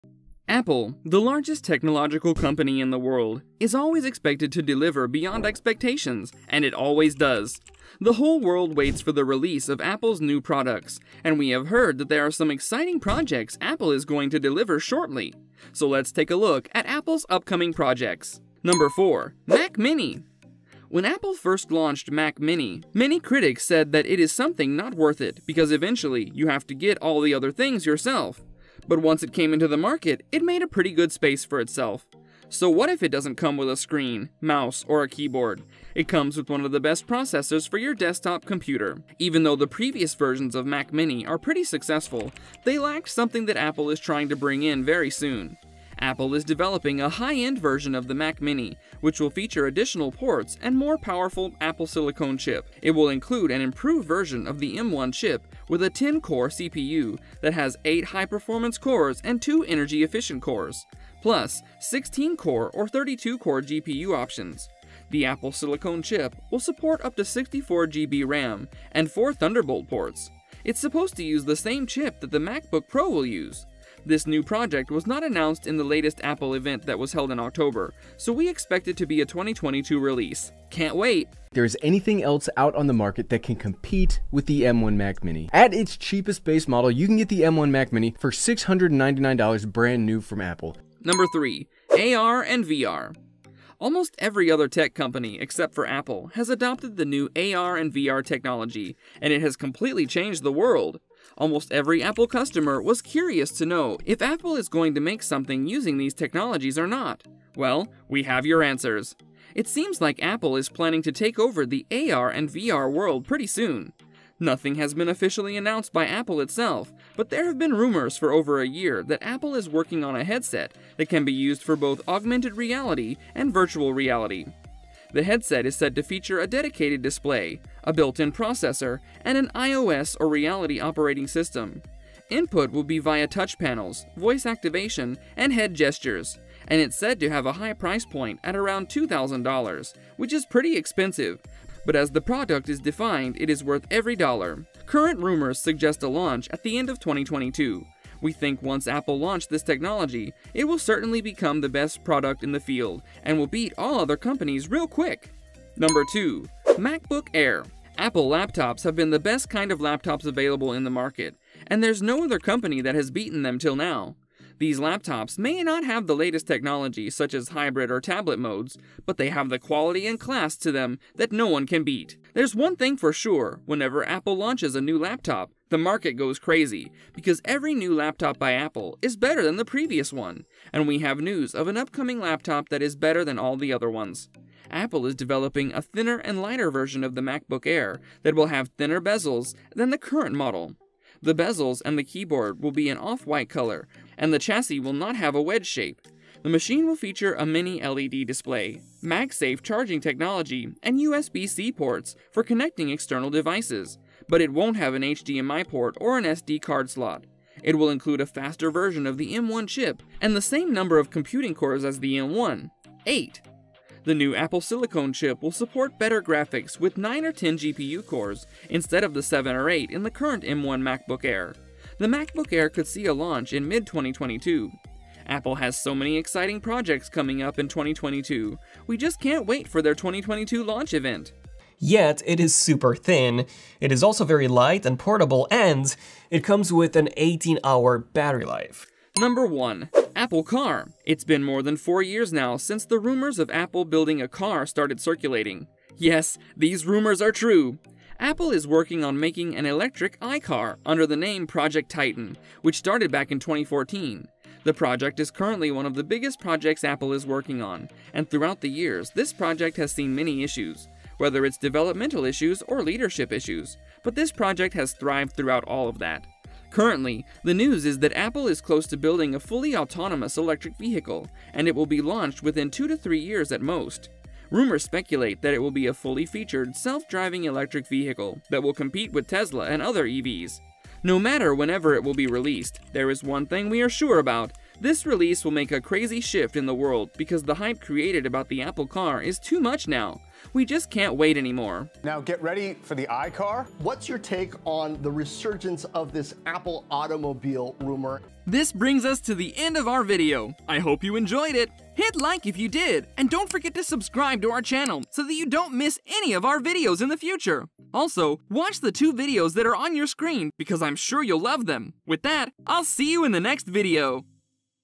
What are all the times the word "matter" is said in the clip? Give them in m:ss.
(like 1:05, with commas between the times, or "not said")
4:41.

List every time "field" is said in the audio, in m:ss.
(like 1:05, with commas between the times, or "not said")
2:32.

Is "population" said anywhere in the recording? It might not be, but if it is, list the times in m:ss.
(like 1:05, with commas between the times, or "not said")
not said.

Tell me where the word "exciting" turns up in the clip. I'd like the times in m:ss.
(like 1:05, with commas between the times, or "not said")
0:12, 3:46.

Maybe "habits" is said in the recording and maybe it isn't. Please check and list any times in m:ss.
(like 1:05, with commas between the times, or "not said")
not said.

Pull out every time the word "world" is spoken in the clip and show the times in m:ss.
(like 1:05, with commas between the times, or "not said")
0:02, 0:08, 1:40, 1:52, 4:46.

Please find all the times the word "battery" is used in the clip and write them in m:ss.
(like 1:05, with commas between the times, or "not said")
3:58.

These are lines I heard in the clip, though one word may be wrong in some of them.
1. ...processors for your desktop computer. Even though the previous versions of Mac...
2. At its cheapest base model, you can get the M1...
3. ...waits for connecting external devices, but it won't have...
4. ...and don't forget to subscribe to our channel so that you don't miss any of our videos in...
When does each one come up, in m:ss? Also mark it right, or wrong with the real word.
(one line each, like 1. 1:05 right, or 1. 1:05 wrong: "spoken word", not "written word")
1. 0:37 right
2. 1:25 right
3. 3:21 wrong: "ports", not "waits"
4. 5:03 right.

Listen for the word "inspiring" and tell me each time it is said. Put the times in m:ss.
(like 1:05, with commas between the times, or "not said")
not said.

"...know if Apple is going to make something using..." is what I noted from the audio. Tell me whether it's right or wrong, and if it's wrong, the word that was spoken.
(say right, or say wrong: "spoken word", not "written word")
right.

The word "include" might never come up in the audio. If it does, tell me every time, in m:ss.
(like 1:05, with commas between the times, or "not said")
0:53, 3:27.